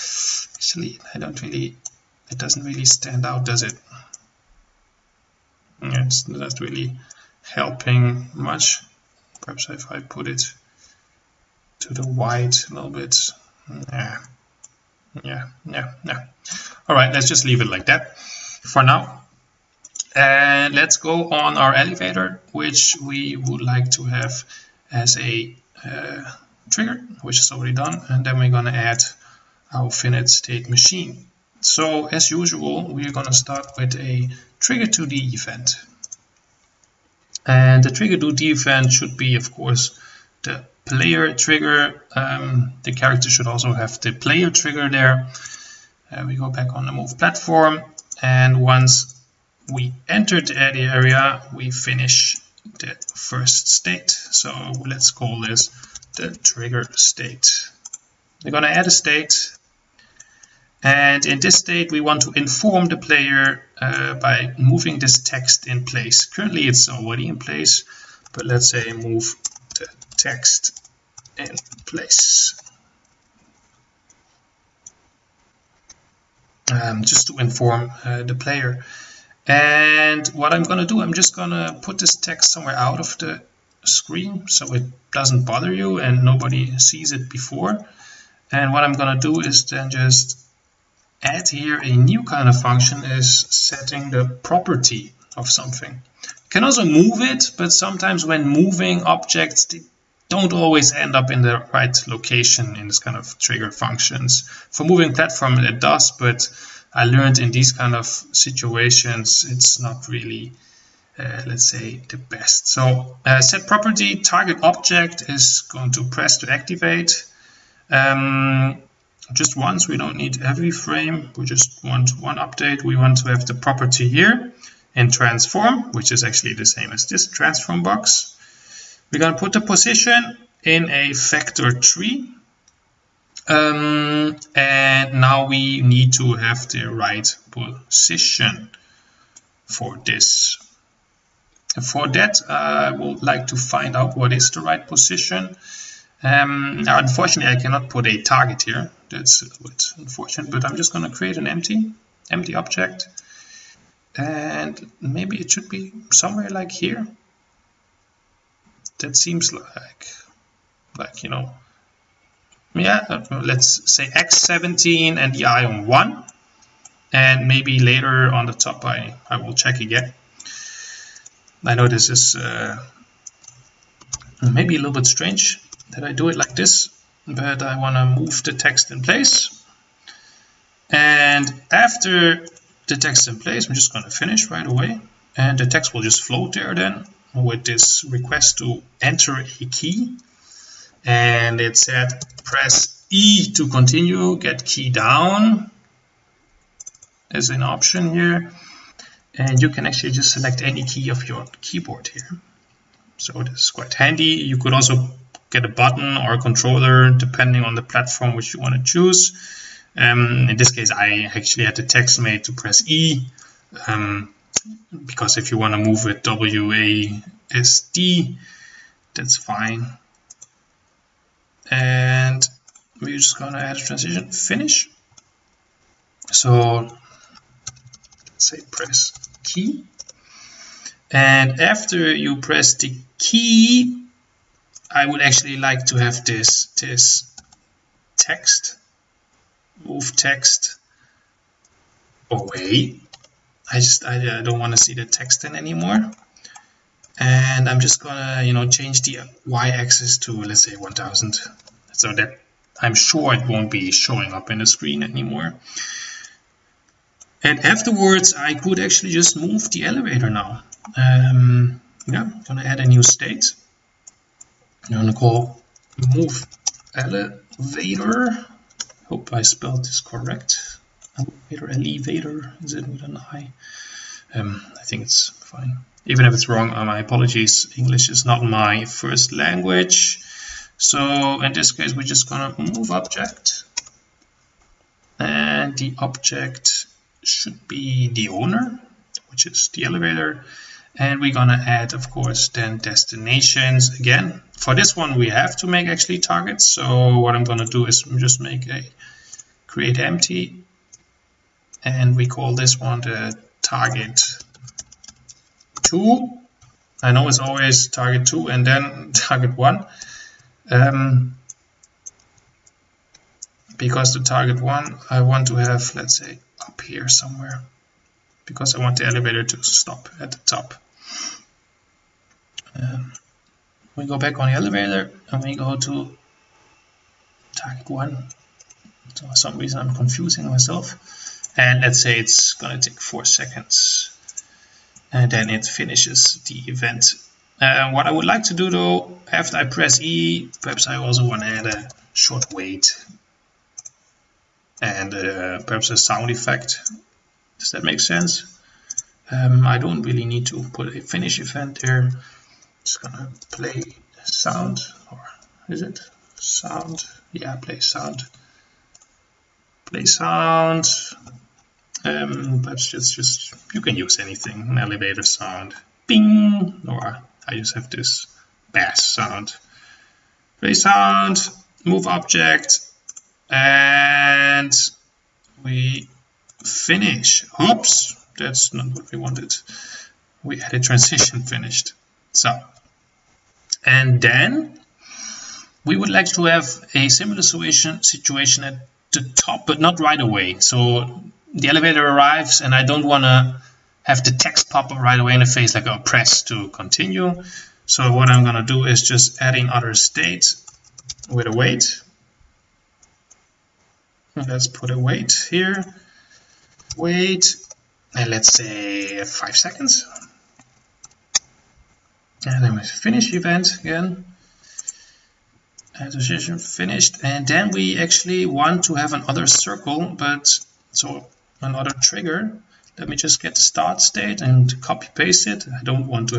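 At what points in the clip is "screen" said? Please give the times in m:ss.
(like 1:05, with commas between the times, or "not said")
1:23, 4:14.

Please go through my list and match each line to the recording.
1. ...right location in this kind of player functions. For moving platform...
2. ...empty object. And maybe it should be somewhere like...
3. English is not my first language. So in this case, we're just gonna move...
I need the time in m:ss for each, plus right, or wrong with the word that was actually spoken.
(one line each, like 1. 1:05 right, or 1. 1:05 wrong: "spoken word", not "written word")
1. 1:41 wrong: "trigger", not "player"
2. 2:32 right
3. 4:37 right.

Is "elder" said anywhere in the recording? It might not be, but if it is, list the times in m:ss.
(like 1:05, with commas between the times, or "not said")
not said.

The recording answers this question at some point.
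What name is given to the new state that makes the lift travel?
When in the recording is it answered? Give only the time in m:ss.
4:26.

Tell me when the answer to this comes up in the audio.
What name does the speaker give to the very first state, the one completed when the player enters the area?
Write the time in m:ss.
0:56.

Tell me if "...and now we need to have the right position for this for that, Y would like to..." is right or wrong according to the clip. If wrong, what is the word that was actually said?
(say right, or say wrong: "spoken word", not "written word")
right.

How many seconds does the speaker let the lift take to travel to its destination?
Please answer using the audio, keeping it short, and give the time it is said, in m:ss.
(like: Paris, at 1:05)
4, at 5:32.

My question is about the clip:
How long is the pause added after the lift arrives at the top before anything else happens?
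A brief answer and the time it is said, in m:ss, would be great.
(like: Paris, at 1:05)
5 seconds, at 6:49.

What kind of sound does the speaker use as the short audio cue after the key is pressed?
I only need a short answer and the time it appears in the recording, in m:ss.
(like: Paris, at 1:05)
Bass sound, at 6:08.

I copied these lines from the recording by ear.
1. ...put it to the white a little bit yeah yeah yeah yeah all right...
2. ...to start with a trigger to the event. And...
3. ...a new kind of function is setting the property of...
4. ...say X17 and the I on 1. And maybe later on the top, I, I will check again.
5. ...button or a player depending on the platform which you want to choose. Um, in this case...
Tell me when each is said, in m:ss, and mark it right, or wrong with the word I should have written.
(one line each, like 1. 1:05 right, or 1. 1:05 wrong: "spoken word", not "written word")
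1. 0:09 right
2. 0:33 right
3. 1:31 right
4. 2:43 right
5. 3:25 wrong: "controller", not "player".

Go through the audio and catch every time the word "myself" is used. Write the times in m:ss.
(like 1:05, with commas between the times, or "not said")
5:30.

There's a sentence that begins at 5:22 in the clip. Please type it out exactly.
Um, we go back on the elevator and we go to target 1.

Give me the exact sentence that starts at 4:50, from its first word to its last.
And we're gonna add, of course, then destinations again.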